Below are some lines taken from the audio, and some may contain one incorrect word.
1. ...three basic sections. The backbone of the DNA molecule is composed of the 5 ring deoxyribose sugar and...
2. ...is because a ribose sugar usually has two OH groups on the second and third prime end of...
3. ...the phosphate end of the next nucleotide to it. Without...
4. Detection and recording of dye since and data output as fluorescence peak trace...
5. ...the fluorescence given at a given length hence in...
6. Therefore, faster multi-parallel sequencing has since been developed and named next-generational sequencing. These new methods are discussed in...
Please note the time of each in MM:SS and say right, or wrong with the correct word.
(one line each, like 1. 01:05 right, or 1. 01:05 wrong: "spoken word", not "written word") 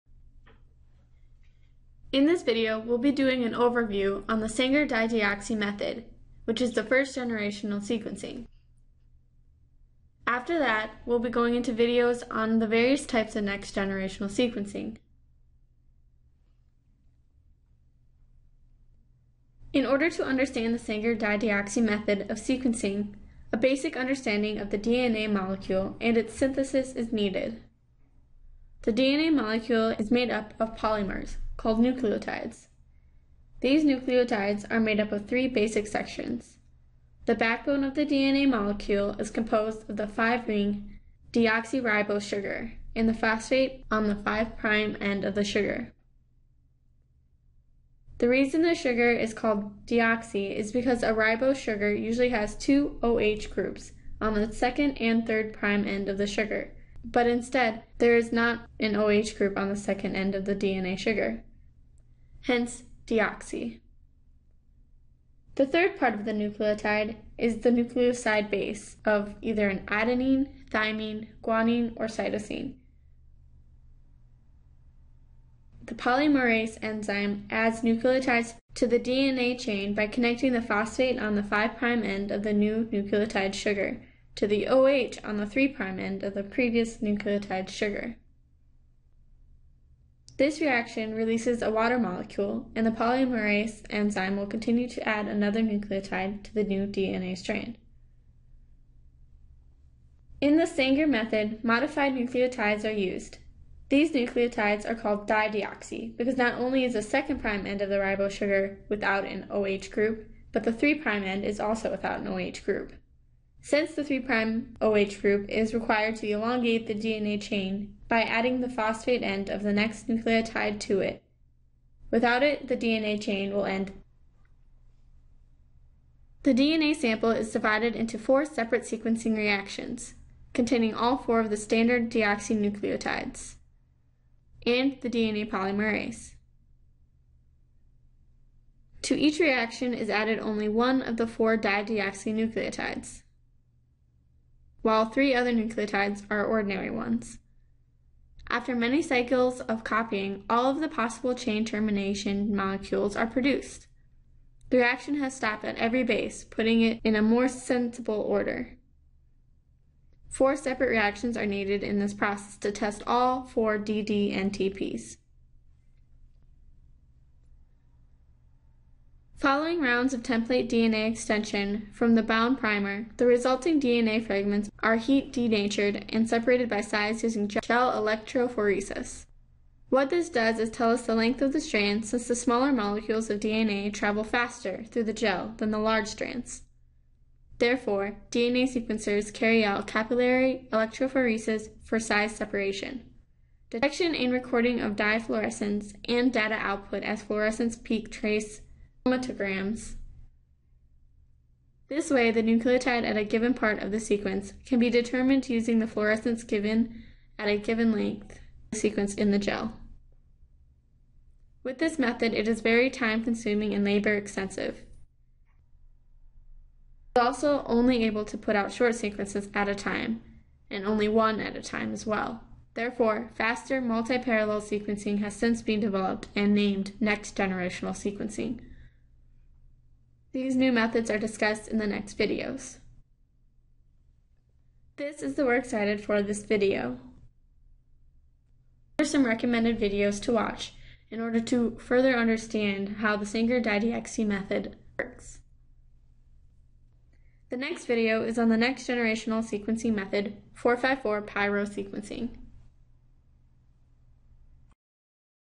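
1. 00:35 right
2. 00:50 right
3. 01:58 right
4. 03:13 wrong: "fluorescence", not "since"
5. 03:25 wrong: "sequence", not "hence"
6. 03:42 right.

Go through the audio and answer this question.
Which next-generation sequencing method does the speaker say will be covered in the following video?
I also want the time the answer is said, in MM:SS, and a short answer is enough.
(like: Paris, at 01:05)
454 pyrosequencing, at 04:10.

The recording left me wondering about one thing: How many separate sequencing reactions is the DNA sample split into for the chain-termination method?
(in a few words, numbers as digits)
4.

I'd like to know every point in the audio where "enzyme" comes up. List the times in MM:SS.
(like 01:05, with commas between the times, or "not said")
01:16, 01:33.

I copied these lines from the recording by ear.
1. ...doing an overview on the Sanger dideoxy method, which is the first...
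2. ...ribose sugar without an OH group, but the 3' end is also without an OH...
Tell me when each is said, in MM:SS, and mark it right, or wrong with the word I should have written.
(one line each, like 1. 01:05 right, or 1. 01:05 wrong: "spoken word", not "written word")
1. 00:03 right
2. 01:47 right.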